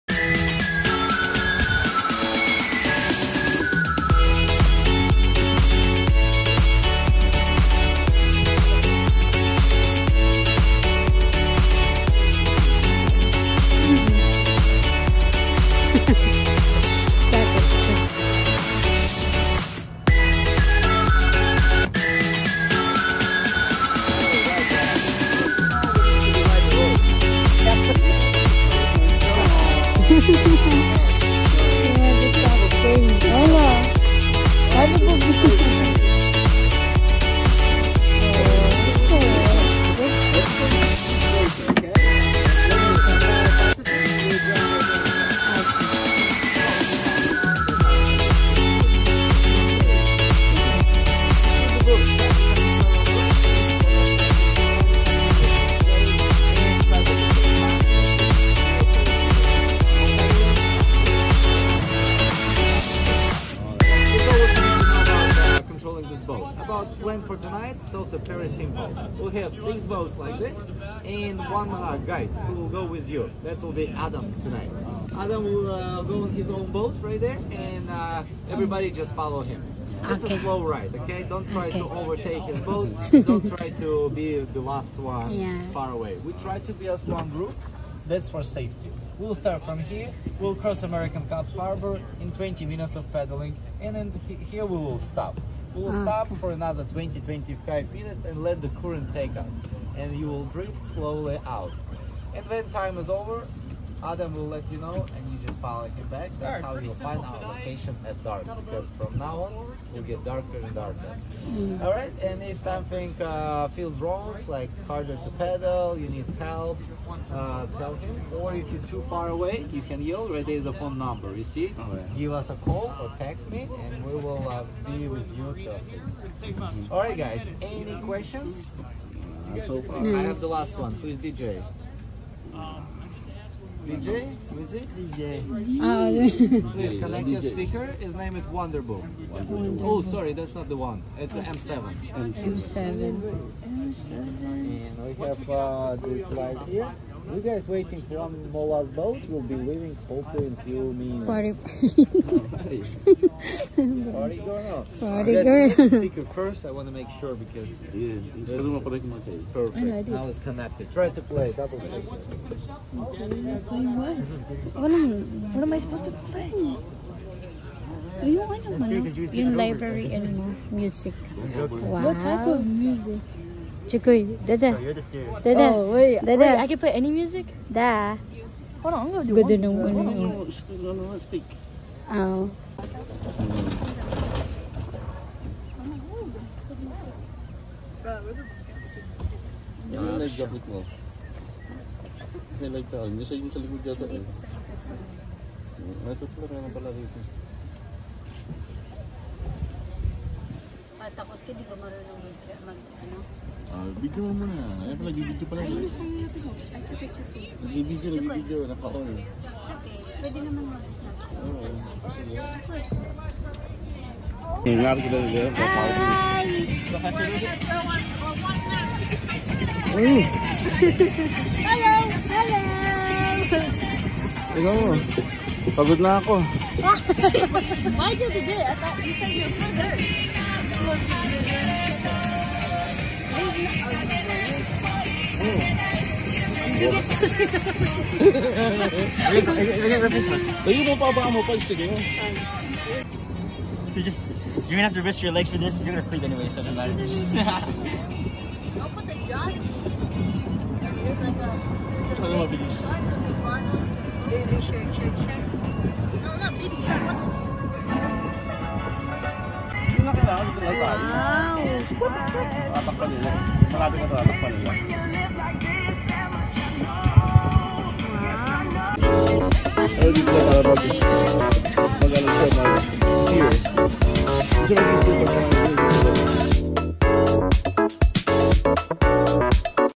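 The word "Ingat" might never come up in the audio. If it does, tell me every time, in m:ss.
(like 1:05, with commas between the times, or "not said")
3:34.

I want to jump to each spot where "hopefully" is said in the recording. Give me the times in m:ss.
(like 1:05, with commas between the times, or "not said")
2:30.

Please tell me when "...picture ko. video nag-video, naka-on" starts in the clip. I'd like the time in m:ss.
3:26.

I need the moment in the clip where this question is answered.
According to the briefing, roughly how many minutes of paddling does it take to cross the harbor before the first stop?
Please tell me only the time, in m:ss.
1:32.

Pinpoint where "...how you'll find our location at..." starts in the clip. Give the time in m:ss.
1:46.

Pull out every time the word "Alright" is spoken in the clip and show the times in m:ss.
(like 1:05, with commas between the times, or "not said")
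1:51, 2:06.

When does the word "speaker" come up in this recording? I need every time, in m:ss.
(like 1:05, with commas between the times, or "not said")
2:17, 2:35.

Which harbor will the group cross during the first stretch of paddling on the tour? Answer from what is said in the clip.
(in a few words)
America's Cup Harbor.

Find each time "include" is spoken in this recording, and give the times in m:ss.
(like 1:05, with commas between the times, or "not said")
not said.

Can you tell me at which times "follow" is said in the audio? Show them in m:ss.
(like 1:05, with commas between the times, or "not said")
1:19, 1:45.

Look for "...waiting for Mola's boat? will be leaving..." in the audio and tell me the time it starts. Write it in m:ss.
2:27.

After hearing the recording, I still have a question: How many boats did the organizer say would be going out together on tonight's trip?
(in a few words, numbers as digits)
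6.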